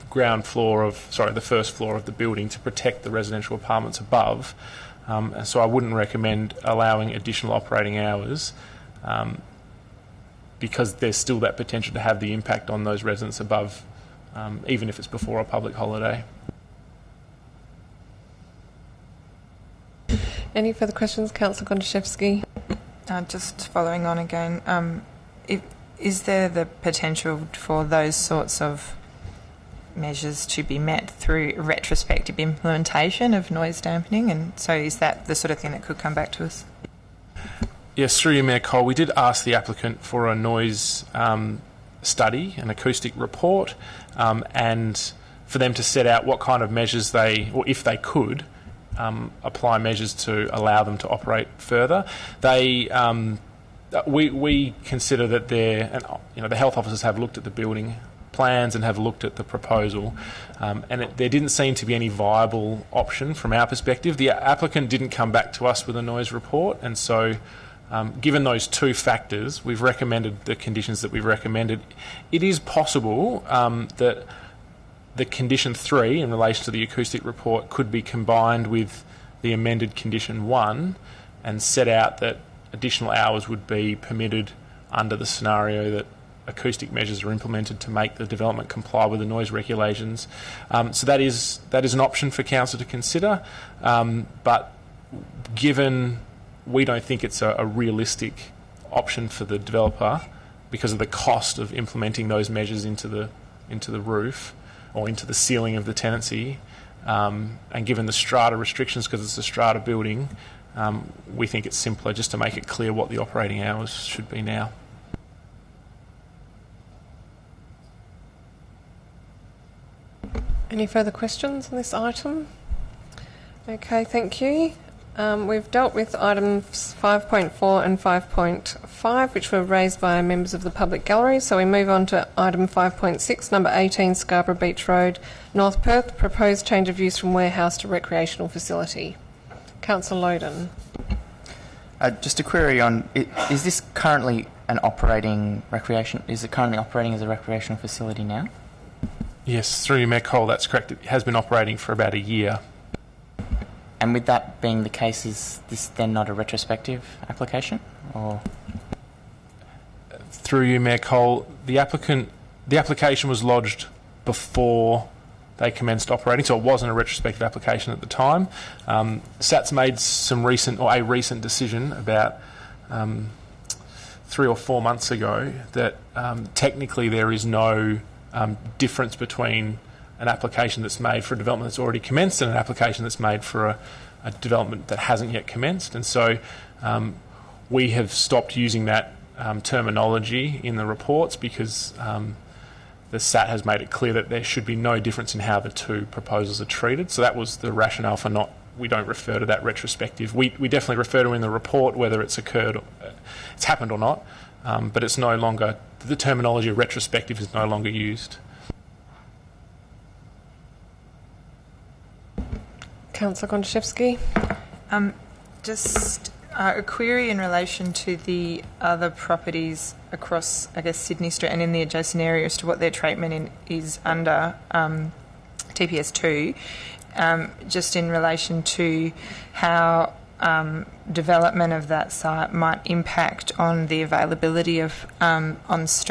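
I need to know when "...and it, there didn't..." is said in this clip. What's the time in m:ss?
1:00.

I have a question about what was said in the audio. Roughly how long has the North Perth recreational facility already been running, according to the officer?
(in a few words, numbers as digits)
About a year.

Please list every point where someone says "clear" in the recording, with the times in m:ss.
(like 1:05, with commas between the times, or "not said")
1:52, 3:13.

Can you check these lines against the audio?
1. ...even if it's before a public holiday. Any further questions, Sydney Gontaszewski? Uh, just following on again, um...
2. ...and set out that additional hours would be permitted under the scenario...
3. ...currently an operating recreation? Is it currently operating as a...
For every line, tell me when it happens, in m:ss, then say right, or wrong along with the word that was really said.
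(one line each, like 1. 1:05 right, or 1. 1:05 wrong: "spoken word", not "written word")
1. 0:14 wrong: "Councillor", not "Sydney"
2. 1:21 right
3. 2:23 right.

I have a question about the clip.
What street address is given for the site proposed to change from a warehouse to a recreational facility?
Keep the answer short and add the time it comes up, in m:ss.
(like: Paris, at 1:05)
18 Scarborough Beach Road, at 2:13.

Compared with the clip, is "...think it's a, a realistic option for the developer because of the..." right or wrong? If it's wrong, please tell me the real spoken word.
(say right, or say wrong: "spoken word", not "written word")
right.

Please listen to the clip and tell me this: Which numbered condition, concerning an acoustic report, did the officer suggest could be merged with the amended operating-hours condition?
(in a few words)
Condition 3.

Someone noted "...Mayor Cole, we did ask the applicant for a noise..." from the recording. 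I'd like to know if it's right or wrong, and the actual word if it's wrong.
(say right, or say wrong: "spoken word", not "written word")
right.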